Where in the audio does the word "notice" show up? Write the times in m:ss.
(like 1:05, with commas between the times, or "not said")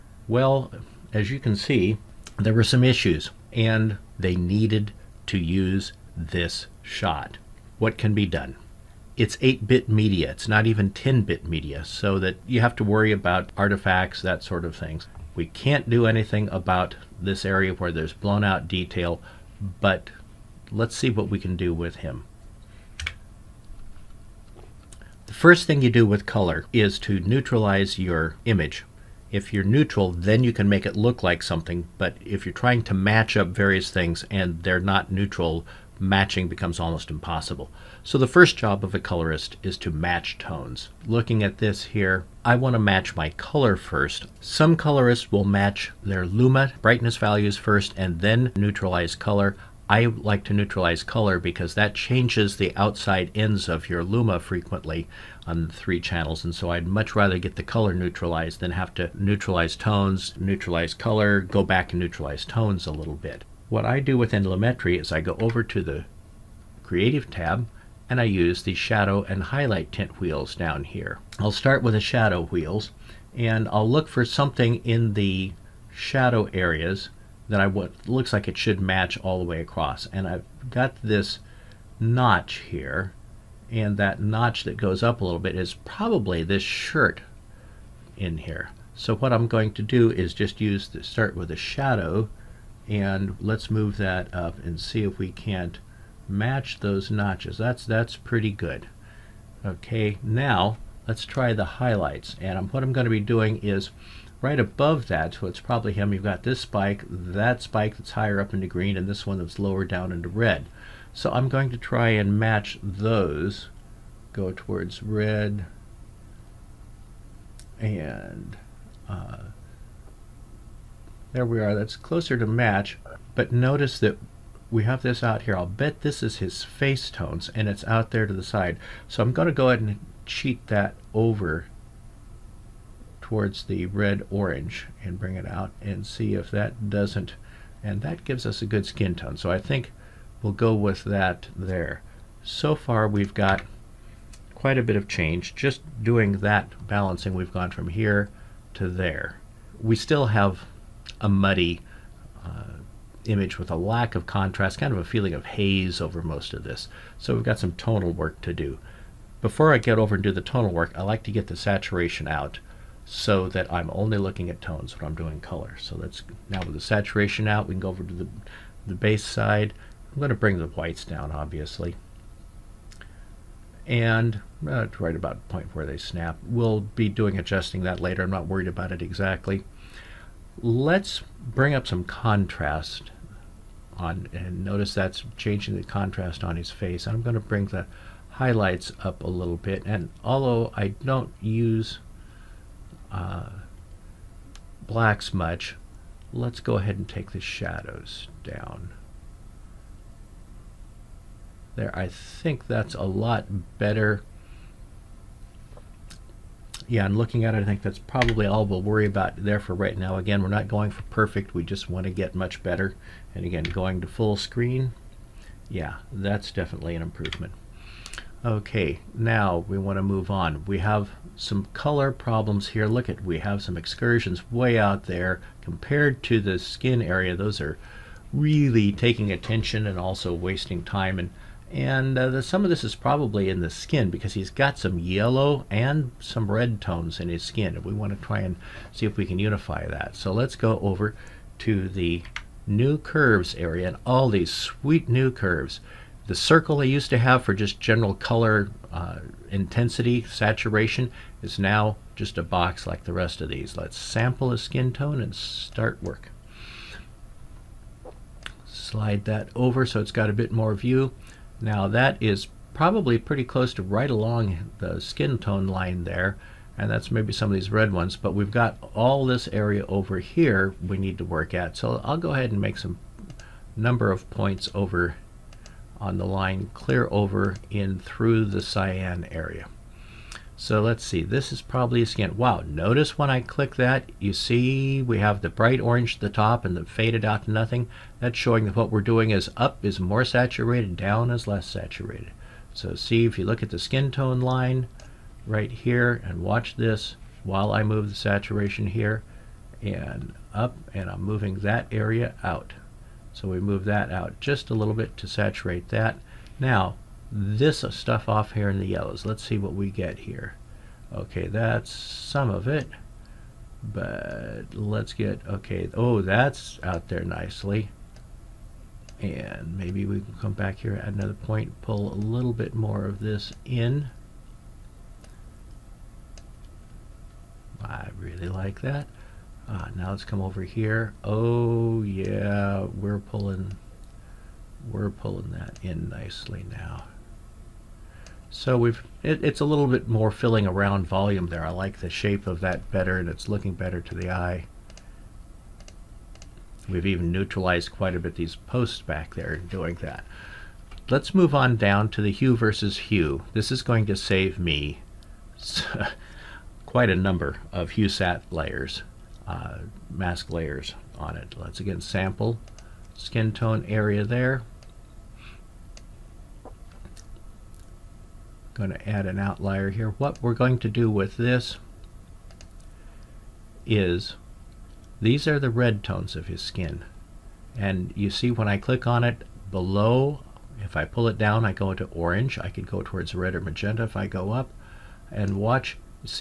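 2:03, 3:04, 4:42.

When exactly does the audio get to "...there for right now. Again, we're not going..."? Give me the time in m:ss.
3:29.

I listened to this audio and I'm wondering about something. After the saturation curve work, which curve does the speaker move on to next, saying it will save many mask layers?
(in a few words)
hue versus hue.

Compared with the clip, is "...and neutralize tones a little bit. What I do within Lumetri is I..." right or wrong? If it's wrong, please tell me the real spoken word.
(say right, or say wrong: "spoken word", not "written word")
right.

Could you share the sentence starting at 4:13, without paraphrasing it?
Let's sample a skin tone and start work.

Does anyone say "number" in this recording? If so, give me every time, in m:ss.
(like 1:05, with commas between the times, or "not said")
4:33, 5:57.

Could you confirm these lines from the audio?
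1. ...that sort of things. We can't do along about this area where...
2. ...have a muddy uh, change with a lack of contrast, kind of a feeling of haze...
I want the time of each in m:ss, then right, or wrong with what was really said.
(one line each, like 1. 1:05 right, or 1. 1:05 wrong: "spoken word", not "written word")
1. 0:14 wrong: "anything", not "along"
2. 2:30 wrong: "image", not "change".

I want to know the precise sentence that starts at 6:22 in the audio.
I could go towards red or magenta if I go up.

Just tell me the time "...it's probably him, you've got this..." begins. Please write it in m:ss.
1:45.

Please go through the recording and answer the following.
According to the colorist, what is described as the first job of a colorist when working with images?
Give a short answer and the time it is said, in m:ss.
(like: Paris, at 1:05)
match tones, at 0:39.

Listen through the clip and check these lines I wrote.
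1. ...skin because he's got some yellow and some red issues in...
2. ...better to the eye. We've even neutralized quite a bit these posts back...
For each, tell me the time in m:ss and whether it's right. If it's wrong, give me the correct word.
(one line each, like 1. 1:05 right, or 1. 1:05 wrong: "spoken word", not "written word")
1. 3:53 wrong: "tones", not "issues"
2. 5:43 right.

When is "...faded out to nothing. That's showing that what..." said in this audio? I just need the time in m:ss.
4:46.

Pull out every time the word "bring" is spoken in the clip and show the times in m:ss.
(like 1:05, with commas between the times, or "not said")
2:15, 2:50, 3:01, 3:07.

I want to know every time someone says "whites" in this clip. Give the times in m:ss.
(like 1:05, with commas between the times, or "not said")
2:50.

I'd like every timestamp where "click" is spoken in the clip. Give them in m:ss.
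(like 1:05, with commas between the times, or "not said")
4:43, 6:18.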